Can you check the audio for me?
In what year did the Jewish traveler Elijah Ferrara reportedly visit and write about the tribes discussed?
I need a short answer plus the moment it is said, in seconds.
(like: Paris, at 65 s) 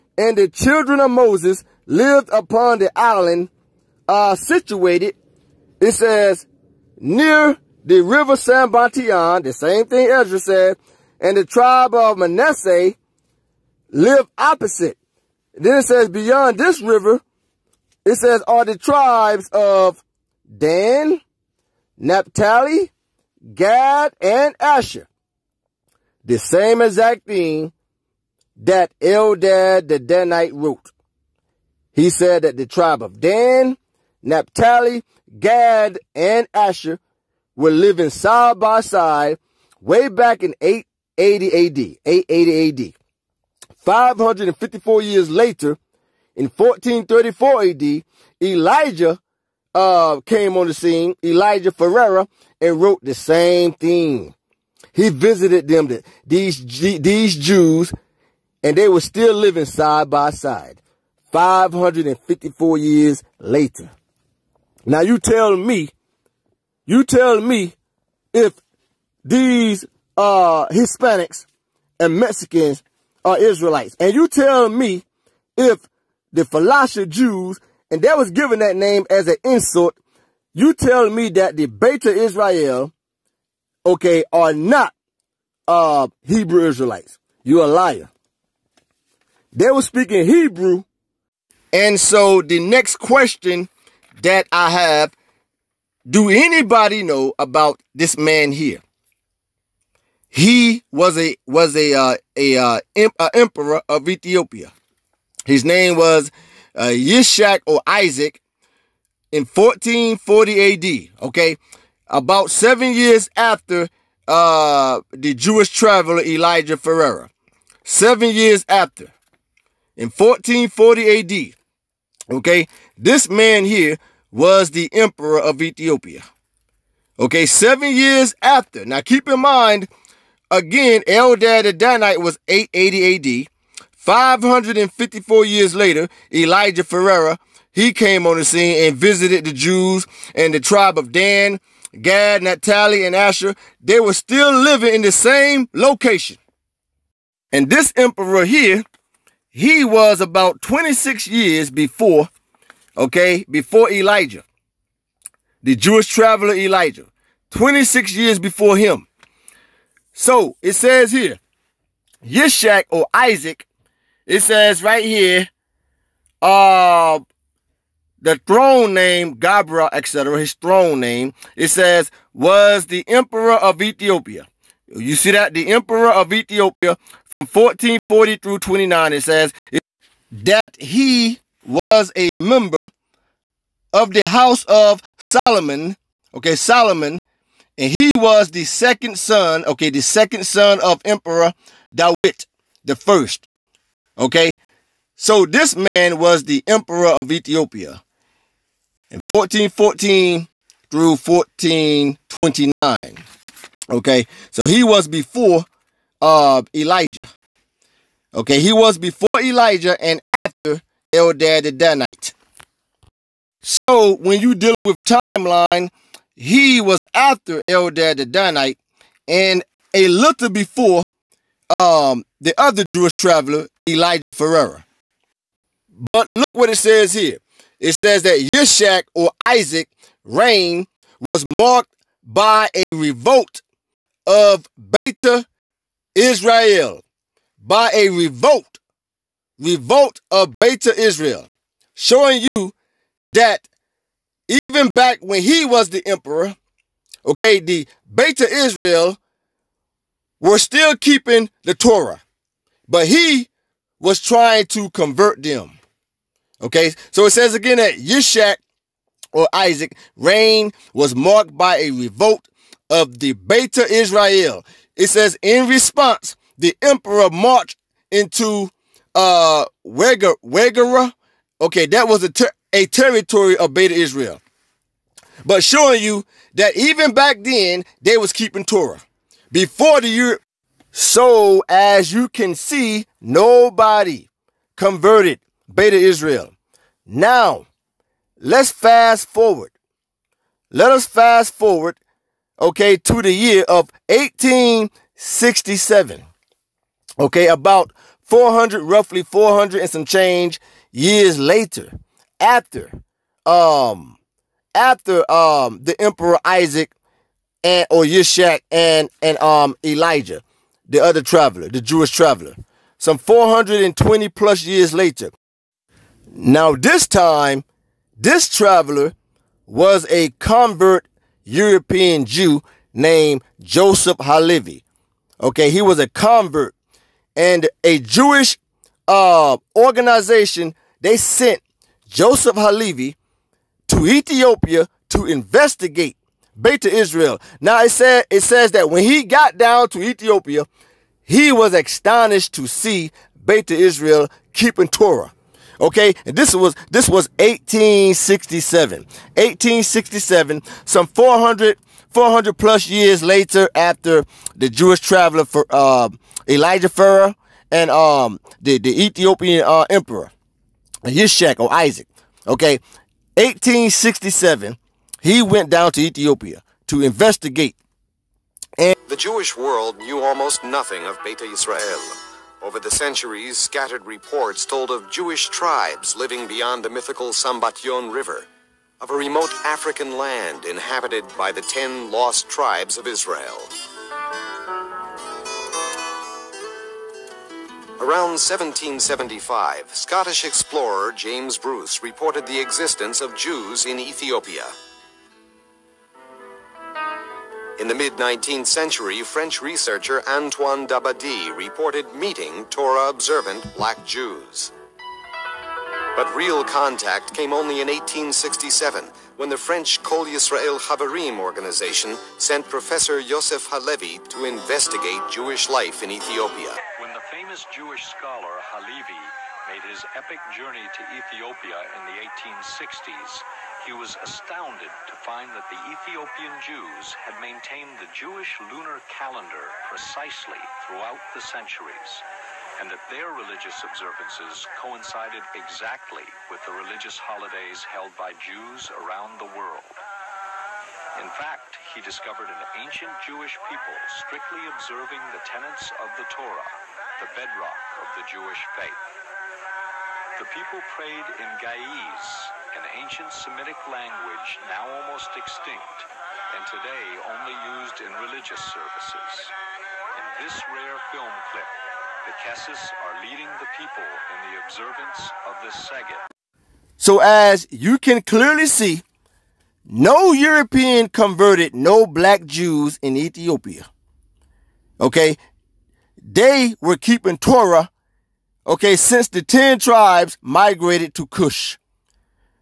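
1434 AD, at 46 s.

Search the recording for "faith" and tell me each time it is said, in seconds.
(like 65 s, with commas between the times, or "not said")
448 s.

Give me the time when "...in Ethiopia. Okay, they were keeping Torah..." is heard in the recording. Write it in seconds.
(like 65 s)
472 s.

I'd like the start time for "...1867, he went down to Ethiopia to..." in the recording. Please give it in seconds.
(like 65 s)
363 s.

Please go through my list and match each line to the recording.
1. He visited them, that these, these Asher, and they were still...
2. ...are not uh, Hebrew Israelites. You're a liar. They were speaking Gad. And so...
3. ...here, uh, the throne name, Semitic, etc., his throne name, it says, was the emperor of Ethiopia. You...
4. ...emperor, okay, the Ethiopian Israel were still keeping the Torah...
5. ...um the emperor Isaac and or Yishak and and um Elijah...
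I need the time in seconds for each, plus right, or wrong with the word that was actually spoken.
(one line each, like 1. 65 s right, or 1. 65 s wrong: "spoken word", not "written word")
1. 54 s wrong: "Jews", not "Asher"
2. 84 s wrong: "Hebrew", not "Gad"
3. 165 s wrong: "Gabra", not "Semitic"
4. 246 s wrong: "Beta", not "Ethiopian"
5. 305 s right.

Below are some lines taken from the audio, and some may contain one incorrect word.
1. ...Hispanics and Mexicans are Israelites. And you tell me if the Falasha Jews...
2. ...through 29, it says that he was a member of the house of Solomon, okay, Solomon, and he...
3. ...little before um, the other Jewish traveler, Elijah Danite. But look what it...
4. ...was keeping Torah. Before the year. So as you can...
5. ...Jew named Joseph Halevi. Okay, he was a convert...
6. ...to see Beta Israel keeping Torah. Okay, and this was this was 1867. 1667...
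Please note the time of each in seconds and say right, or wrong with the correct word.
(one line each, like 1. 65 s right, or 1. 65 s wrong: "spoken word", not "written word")
1. 70 s right
2. 178 s right
3. 220 s wrong: "Ferrara", not "Danite"
4. 278 s right
5. 322 s right
6. 342 s wrong: "1867", not "1667".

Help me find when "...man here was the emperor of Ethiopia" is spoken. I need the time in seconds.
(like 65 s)
123 s.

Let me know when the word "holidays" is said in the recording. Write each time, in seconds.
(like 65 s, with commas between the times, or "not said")
437 s.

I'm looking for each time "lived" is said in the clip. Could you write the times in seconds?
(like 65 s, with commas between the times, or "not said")
1 s, 13 s.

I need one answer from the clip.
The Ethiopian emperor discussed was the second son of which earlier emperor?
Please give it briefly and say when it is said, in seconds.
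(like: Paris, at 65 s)
Dawit the first, at 191 s.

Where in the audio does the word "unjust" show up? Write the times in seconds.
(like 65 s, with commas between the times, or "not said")
not said.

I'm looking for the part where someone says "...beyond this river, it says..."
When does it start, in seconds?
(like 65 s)
16 s.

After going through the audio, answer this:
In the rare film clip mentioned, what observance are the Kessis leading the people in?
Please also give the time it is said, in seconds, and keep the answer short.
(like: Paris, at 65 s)
Seged, at 465 s.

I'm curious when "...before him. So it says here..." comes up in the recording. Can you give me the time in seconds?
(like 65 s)
158 s.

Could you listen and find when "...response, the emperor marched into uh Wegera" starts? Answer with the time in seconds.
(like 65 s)
265 s.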